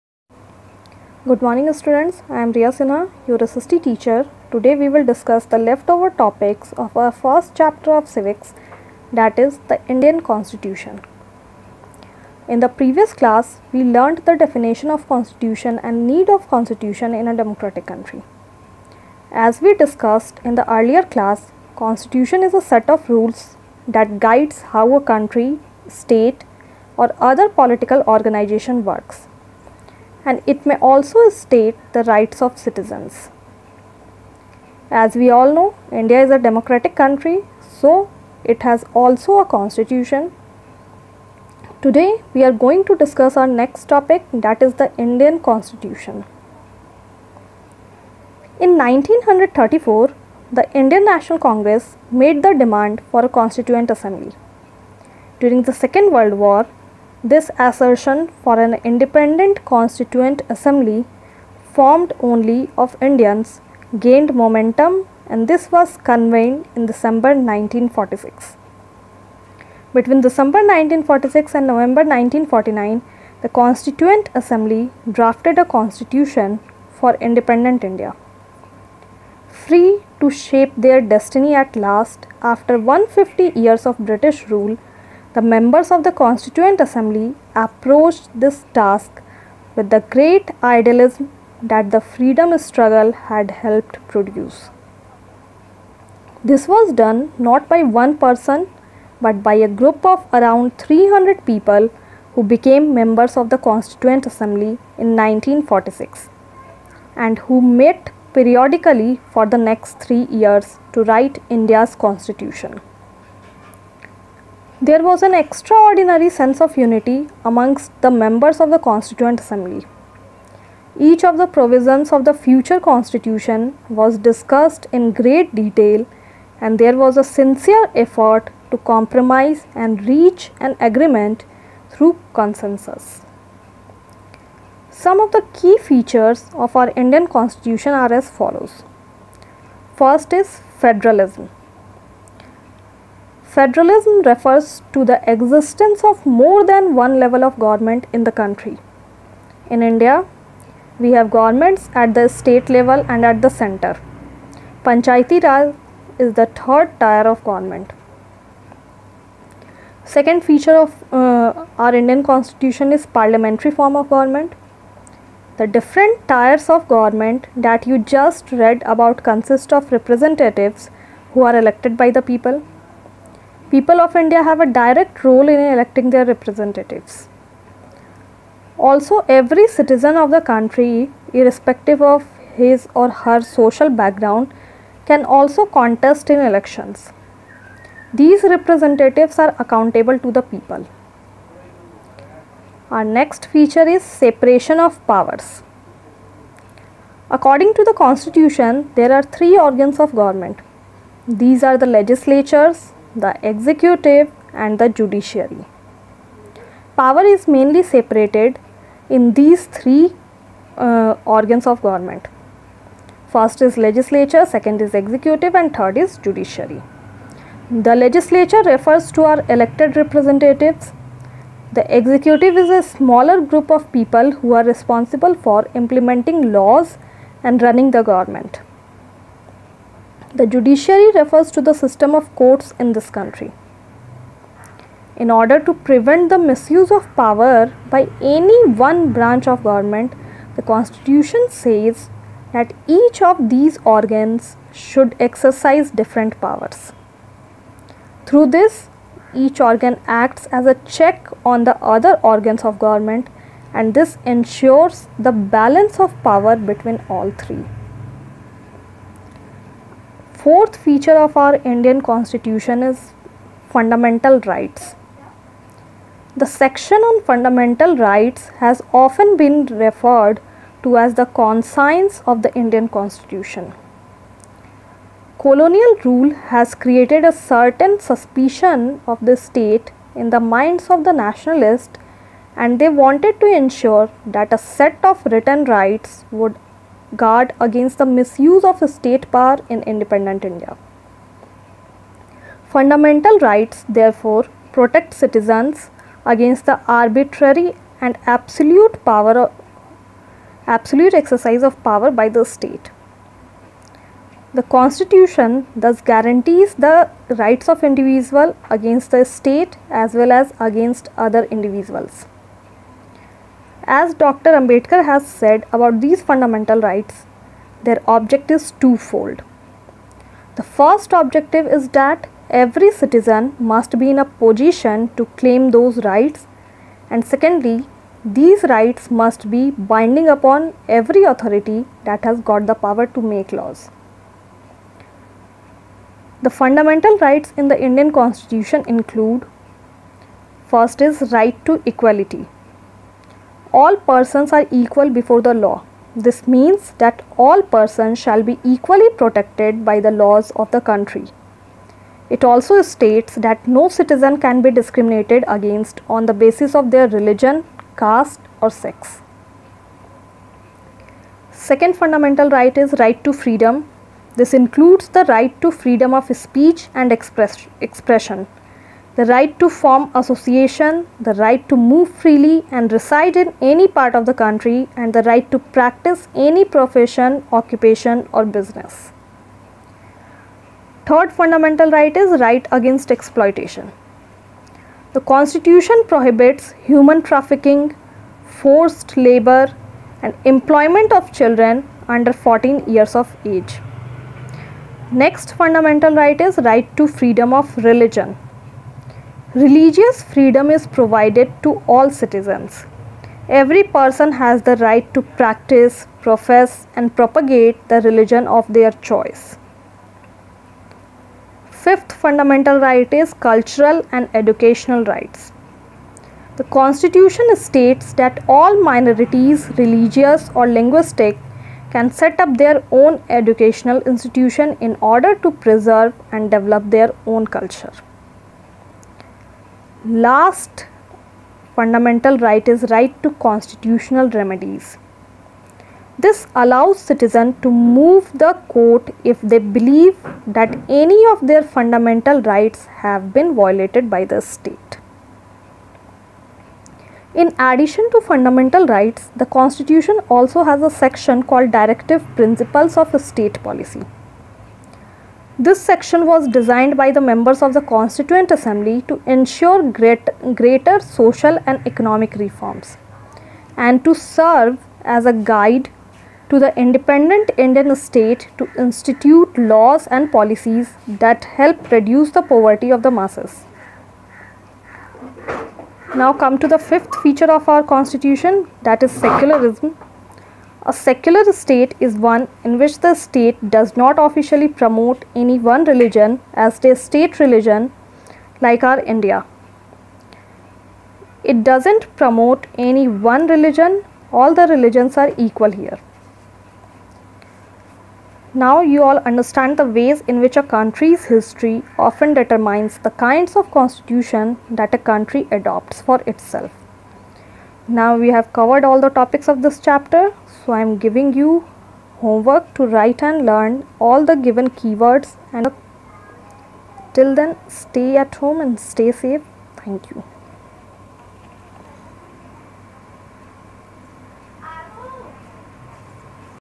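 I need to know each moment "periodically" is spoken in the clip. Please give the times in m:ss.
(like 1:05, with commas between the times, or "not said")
1:48.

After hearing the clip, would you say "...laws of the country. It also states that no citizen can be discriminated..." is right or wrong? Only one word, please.
right.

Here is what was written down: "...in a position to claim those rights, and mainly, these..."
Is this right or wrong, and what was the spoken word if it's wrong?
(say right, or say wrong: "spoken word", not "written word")
wrong: "secondly", not "mainly".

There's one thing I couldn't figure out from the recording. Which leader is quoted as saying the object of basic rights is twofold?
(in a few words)
Dr. Ambedkar.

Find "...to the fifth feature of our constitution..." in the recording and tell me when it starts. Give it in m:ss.
7:56.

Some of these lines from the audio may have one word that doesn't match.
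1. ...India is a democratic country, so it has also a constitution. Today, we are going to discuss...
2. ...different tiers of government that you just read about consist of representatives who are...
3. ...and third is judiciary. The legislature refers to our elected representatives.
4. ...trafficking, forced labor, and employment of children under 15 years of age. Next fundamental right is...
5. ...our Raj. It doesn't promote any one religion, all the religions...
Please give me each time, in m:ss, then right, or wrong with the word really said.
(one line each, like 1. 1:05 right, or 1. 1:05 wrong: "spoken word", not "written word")
1. 0:35 right
2. 2:45 right
3. 3:35 right
4. 6:27 wrong: "14", not "15"
5. 8:08 wrong: "India", not "Raj".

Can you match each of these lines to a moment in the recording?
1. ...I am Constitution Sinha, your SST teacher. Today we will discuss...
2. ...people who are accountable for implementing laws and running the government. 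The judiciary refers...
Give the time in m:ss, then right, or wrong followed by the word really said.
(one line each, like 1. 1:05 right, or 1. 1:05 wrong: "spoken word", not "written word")
1. 0:02 wrong: "Riya", not "Constitution"
2. 3:43 wrong: "responsible", not "accountable".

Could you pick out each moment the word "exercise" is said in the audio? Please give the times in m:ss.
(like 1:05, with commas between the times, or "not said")
4:05, 5:01.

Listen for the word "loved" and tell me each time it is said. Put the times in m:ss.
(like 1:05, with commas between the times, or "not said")
not said.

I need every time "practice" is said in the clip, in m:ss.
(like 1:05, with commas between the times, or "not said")
6:15, 6:45.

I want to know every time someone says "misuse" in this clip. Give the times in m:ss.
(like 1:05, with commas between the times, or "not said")
3:56, 4:48.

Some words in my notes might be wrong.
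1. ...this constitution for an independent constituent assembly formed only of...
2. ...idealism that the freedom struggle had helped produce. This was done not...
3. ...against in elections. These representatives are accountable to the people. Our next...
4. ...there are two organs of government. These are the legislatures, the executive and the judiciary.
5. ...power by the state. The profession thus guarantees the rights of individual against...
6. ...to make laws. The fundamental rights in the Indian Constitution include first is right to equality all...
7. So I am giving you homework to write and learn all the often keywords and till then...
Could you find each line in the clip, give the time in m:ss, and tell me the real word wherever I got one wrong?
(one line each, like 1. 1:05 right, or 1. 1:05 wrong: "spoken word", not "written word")
1. 0:57 wrong: "assertion", not "constitution"
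2. 1:30 right
3. 3:05 wrong: "contest", not "against"
4. 3:18 wrong: "three", not "two"
5. 5:01 wrong: "constitution", not "profession"
6. 5:33 right
7. 8:30 wrong: "given", not "often".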